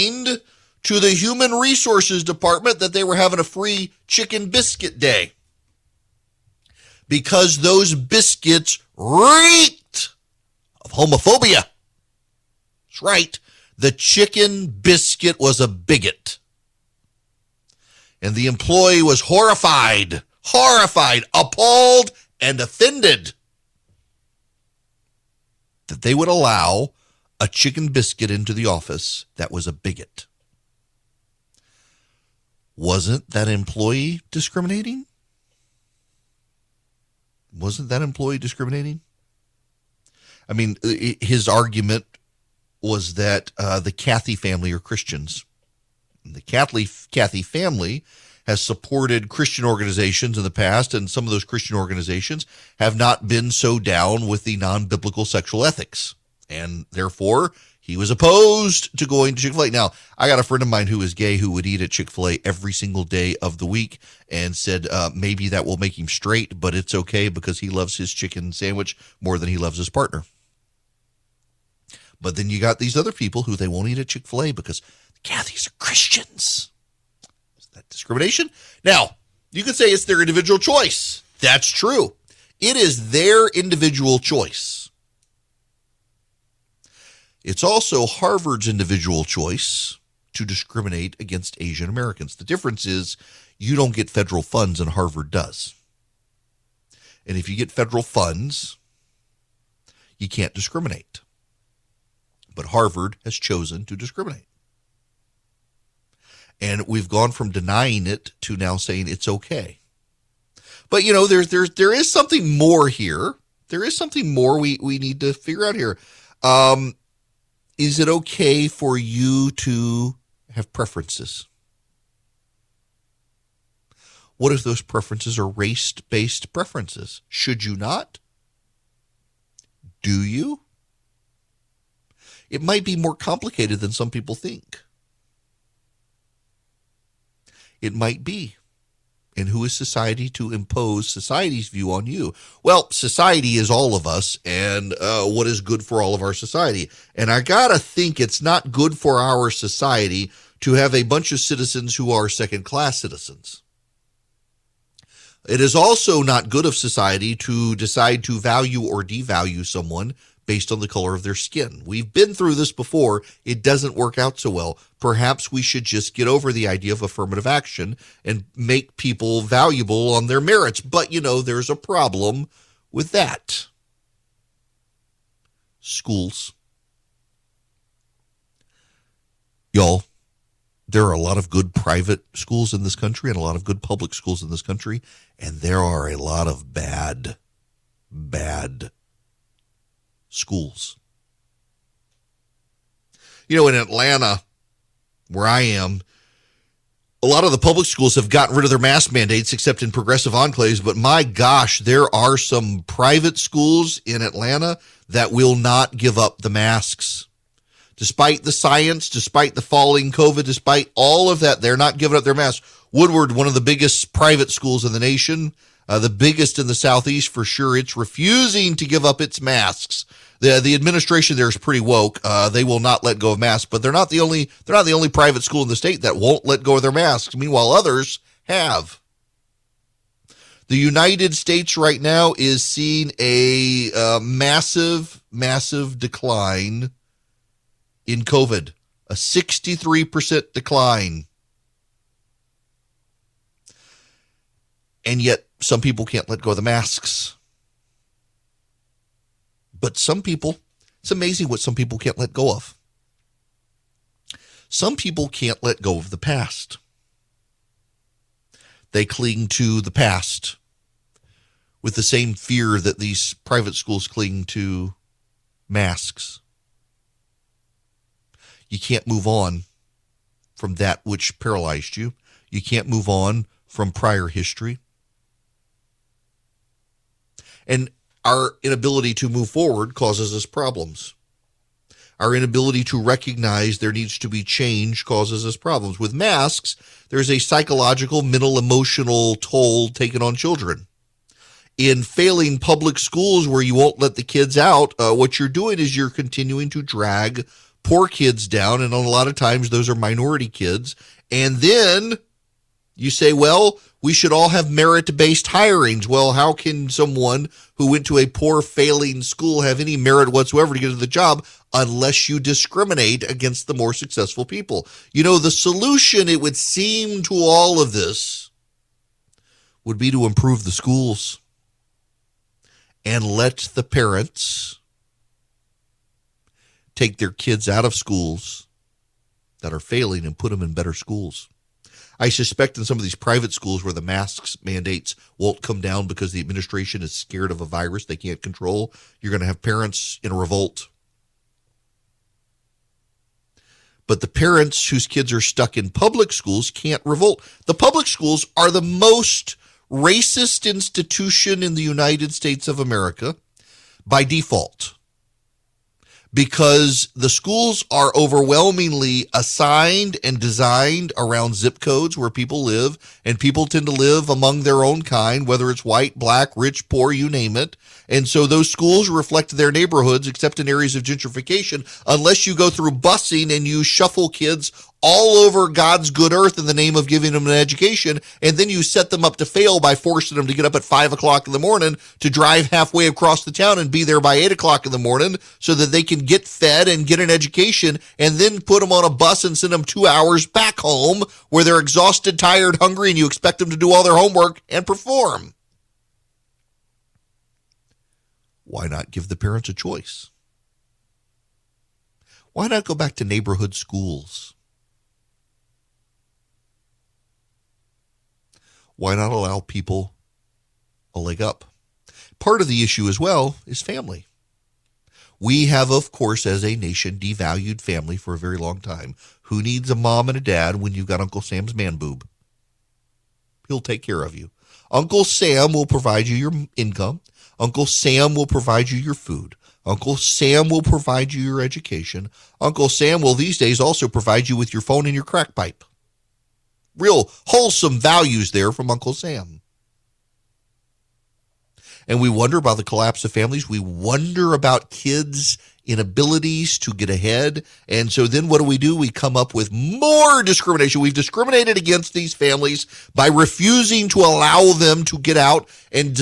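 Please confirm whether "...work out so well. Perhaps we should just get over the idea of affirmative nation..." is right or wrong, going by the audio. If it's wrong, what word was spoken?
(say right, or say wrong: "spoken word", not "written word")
wrong: "action", not "nation".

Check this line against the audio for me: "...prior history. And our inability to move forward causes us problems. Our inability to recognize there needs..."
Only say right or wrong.
right.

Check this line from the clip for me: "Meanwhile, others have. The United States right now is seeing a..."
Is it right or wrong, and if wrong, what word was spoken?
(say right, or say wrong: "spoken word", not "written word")
right.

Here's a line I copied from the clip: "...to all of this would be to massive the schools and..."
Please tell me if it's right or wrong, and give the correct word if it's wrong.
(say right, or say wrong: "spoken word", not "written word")
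wrong: "improve", not "massive".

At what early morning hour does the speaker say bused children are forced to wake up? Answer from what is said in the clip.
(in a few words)
5 o'clock.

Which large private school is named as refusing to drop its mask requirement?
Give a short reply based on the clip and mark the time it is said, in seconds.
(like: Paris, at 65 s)
Woodward, at 212 s.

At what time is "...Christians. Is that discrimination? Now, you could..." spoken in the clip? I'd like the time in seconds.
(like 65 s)
75 s.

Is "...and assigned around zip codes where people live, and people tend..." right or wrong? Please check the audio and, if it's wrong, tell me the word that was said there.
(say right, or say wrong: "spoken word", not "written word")
wrong: "designed", not "assigned".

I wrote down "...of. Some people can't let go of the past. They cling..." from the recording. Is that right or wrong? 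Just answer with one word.
right.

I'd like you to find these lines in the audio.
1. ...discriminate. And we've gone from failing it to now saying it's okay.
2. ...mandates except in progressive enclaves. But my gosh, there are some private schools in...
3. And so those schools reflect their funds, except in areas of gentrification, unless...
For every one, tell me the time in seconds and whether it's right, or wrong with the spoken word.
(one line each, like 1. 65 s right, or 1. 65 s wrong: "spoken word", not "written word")
1. 103 s wrong: "denying", not "failing"
2. 199 s right
3. 368 s wrong: "neighborhoods", not "funds".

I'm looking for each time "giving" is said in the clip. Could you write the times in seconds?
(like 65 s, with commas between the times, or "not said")
211 s, 377 s.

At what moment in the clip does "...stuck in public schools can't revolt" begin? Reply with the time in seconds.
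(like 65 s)
345 s.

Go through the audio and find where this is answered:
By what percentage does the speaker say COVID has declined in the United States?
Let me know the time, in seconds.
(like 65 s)
239 s.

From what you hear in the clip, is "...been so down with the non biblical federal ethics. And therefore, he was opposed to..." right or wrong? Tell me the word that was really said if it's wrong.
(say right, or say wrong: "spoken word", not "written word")
wrong: "sexual", not "federal".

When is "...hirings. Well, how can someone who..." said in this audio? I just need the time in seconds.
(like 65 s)
305 s.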